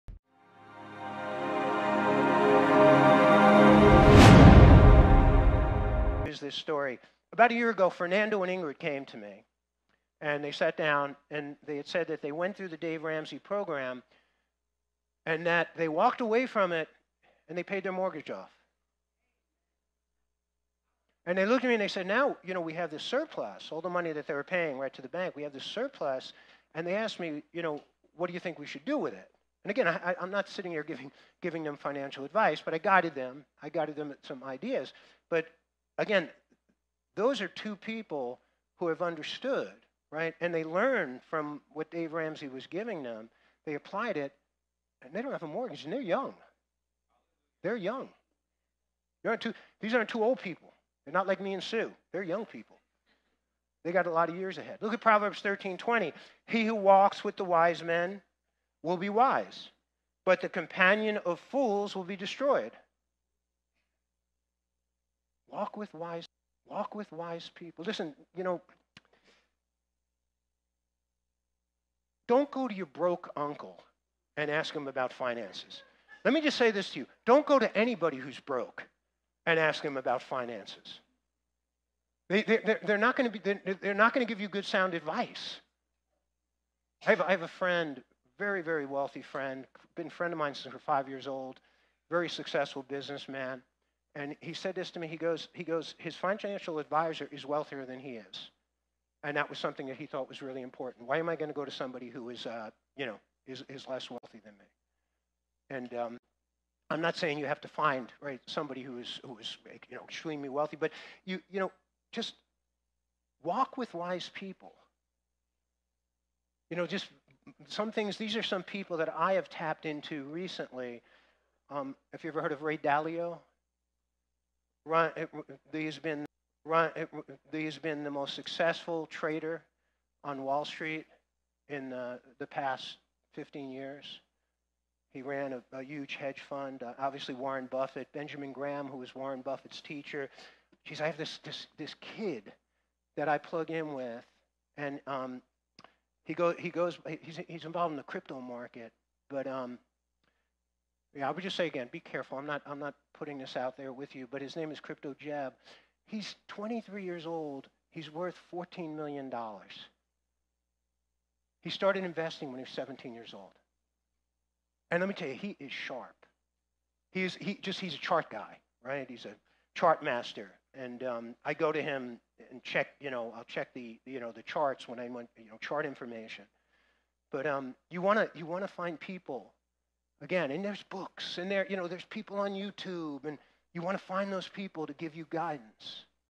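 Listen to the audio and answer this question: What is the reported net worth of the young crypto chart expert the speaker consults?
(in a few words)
$14 million.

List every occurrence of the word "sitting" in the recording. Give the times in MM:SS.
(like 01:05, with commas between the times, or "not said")
00:30.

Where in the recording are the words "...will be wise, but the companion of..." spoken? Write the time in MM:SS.
00:58.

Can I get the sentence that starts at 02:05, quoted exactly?
he's been he's been the most successful trader on Wall Street in the, the past 15 years.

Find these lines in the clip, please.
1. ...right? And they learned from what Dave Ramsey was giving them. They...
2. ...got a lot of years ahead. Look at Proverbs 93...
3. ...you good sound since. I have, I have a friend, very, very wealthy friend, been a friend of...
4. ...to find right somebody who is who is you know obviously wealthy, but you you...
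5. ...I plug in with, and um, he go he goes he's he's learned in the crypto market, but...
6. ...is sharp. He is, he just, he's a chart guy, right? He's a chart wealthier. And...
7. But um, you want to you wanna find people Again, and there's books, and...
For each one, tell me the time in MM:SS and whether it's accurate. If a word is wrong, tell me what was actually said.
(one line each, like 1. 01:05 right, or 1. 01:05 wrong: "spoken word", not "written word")
1. 00:40 right
2. 00:53 wrong: "13", not "93"
3. 01:24 wrong: "advice", not "since"
4. 01:47 wrong: "extremely", not "obviously"
5. 02:23 wrong: "involved", not "learned"
6. 02:45 wrong: "master", not "wealthier"
7. 02:57 right.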